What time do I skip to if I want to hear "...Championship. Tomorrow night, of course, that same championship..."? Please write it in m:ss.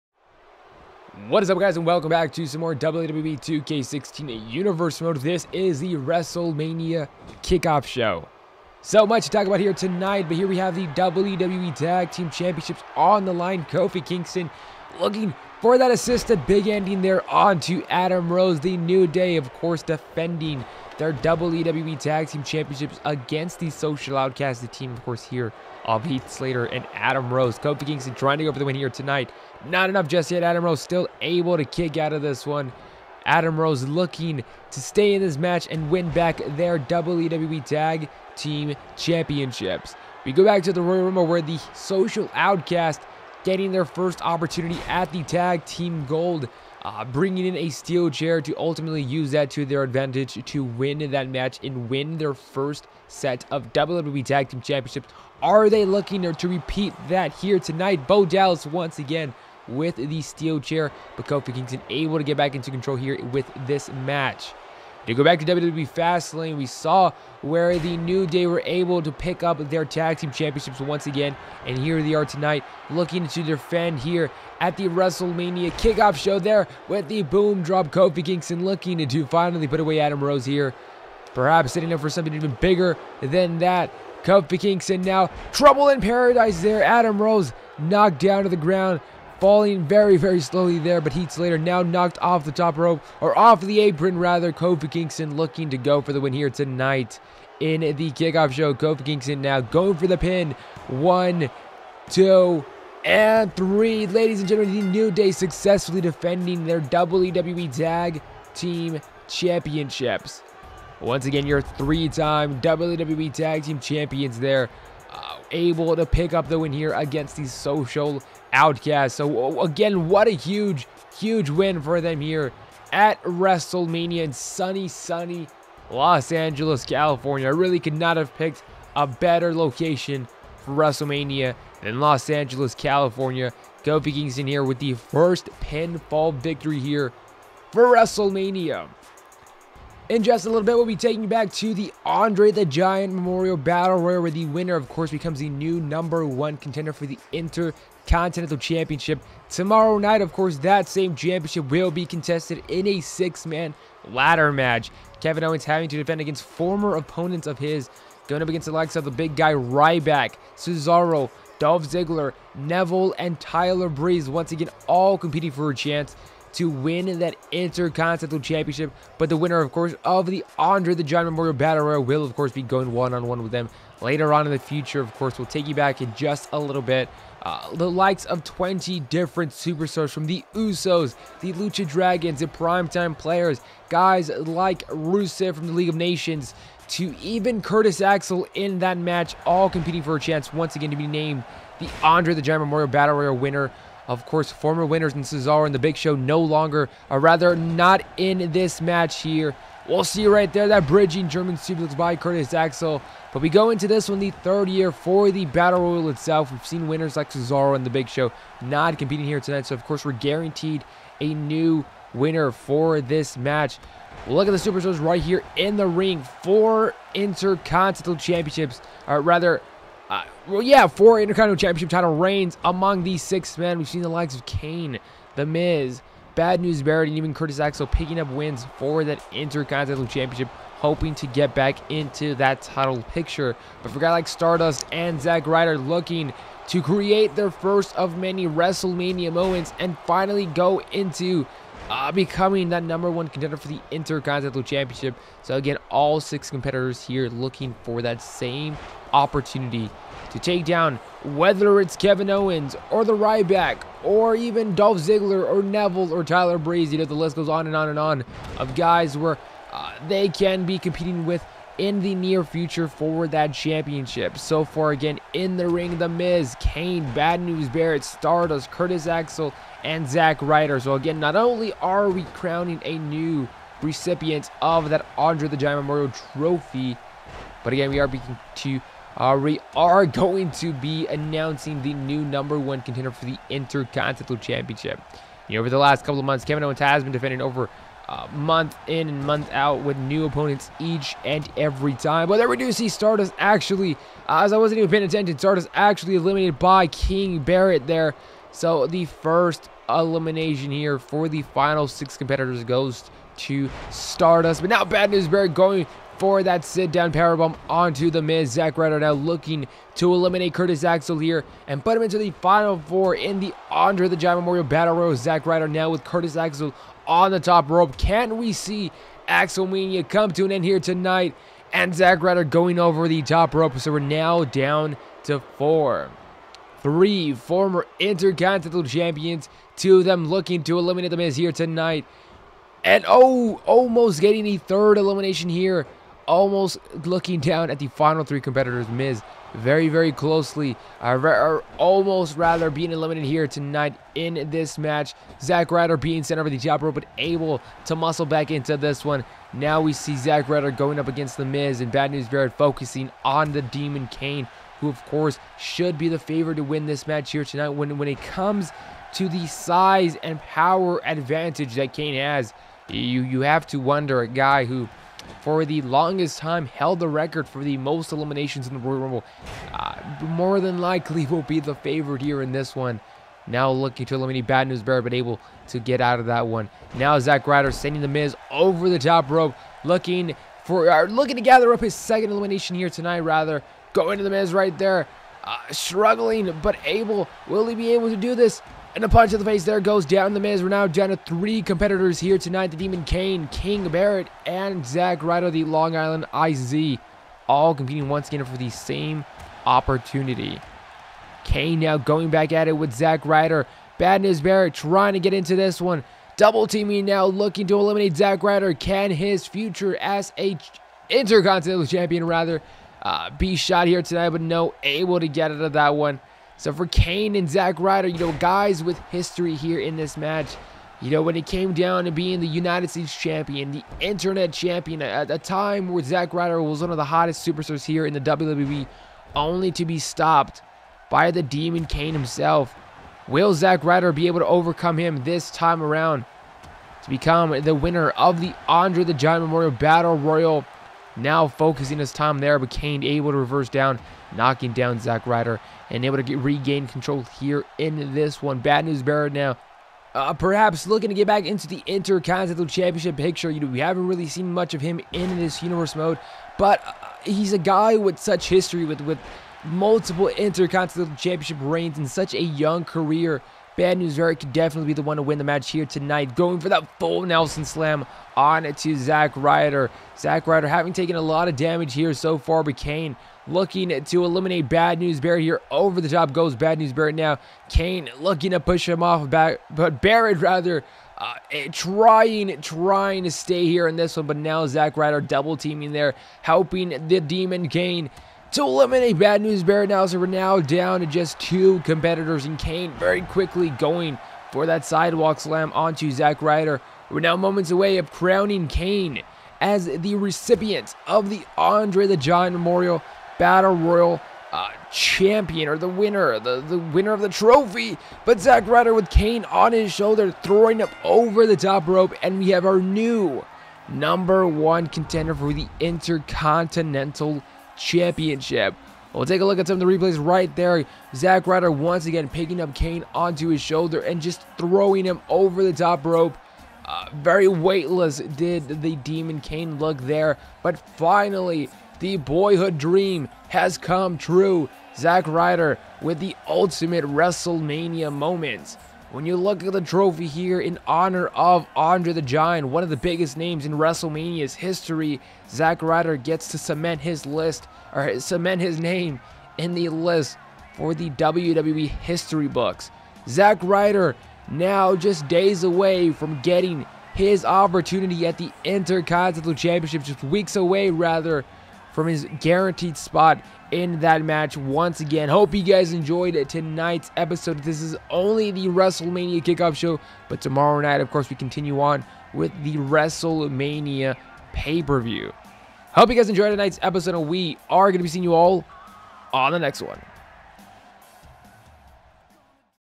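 2:28.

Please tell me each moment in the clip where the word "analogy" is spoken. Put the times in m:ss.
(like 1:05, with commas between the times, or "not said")
not said.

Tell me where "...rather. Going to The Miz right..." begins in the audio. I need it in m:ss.
6:23.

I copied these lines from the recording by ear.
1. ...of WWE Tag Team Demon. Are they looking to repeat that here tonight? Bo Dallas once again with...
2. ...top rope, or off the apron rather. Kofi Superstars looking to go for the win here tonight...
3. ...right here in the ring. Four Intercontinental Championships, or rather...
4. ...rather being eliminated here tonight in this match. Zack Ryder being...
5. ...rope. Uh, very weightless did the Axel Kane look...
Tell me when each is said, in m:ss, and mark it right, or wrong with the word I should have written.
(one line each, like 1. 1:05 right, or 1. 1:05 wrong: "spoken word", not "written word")
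1. 0:53 wrong: "Championships", not "Demon"
2. 1:32 wrong: "Kingston", not "Superstars"
3. 3:35 right
4. 5:42 right
5. 8:46 wrong: "Demon", not "Axel".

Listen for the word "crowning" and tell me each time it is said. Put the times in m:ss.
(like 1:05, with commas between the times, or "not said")
4:32, 8:18.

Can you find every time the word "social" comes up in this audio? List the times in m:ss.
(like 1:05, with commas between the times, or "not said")
0:23, 0:41, 1:57.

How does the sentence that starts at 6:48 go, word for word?
Can his future as a Intercontinental Champion rather uh, be shot here tonight?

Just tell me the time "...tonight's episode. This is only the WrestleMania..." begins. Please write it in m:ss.
9:26.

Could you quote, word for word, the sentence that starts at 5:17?
Can we see Axelmania come to an end here tonight?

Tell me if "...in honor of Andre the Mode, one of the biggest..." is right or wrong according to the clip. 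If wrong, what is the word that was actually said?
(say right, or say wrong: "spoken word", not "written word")
wrong: "Giant", not "Mode".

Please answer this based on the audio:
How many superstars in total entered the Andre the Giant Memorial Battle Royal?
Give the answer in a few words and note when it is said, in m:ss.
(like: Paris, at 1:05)
20, at 2:58.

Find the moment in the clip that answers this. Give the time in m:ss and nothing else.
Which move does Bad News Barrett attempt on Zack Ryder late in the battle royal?
7:46.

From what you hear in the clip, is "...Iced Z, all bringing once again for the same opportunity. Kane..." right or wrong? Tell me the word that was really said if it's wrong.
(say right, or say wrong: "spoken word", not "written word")
wrong: "competing", not "bringing".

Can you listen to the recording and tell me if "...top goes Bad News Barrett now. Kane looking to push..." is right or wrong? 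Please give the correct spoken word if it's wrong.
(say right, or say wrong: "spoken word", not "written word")
right.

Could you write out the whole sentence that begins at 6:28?
And a punch to the face there goes down the Miz.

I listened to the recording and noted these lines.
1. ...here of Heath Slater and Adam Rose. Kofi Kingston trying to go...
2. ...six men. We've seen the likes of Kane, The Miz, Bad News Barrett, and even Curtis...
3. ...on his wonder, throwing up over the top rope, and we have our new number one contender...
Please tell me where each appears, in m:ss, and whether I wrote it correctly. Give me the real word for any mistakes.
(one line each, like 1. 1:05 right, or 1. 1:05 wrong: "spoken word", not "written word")
1. 0:25 right
2. 3:43 right
3. 8:29 wrong: "shoulder", not "wonder".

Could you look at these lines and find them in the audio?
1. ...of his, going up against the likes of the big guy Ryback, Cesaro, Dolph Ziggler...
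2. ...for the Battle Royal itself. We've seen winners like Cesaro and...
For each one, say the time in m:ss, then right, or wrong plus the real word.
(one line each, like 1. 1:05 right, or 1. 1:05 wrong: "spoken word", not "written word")
1. 2:37 right
2. 3:24 right.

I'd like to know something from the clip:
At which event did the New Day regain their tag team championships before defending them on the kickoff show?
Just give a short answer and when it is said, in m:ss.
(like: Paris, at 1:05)
WWE Fastlane, at 1:05.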